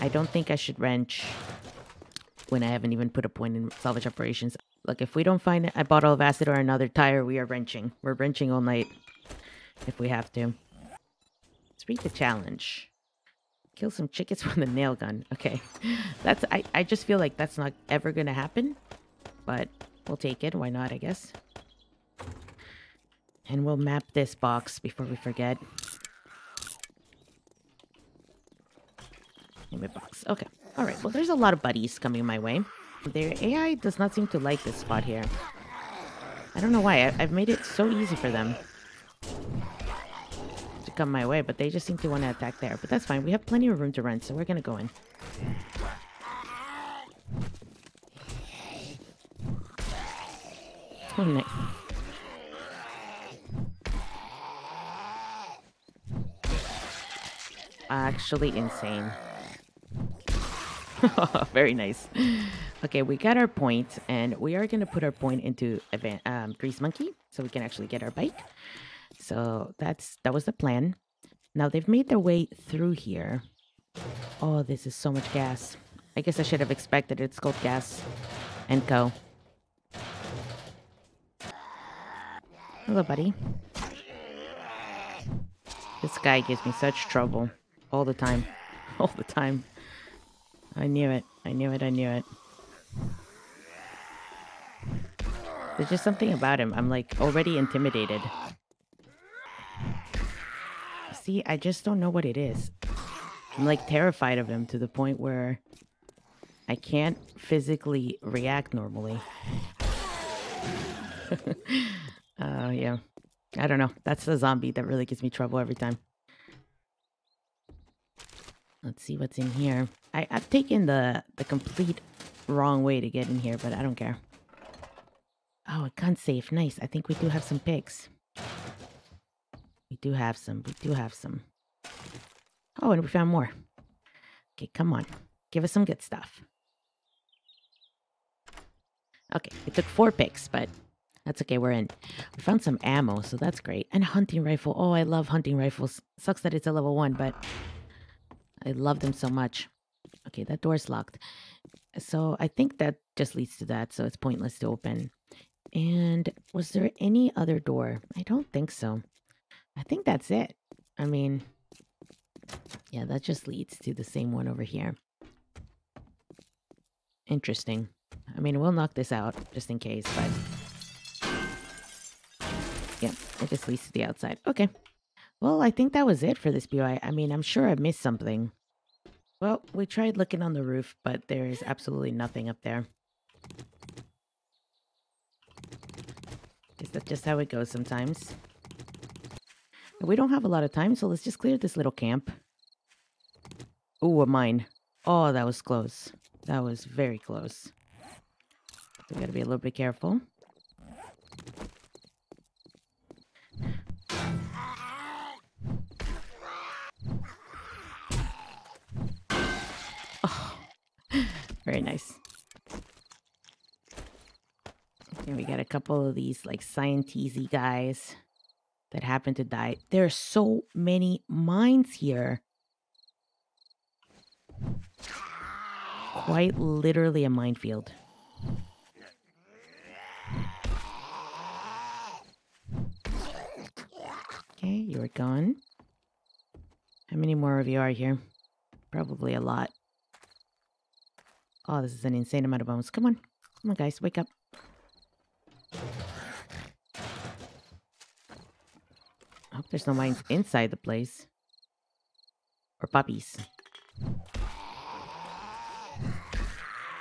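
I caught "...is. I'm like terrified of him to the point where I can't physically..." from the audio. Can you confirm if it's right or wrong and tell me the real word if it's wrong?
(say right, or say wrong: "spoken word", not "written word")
right.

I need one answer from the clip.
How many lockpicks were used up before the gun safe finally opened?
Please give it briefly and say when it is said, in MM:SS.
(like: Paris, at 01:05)
4, at 02:19.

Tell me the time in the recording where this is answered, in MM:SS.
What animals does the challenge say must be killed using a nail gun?
00:14.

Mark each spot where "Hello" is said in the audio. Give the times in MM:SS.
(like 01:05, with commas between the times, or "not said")
01:22.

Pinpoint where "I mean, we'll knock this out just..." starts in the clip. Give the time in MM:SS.
02:48.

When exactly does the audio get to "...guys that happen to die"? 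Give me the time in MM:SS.
03:37.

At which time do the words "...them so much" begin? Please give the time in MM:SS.
02:28.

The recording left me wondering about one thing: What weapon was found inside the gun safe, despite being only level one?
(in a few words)
Hunting rifle.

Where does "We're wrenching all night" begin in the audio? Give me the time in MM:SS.
00:08.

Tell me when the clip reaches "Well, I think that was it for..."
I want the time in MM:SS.
02:55.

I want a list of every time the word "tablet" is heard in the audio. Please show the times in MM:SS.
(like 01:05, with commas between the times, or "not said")
not said.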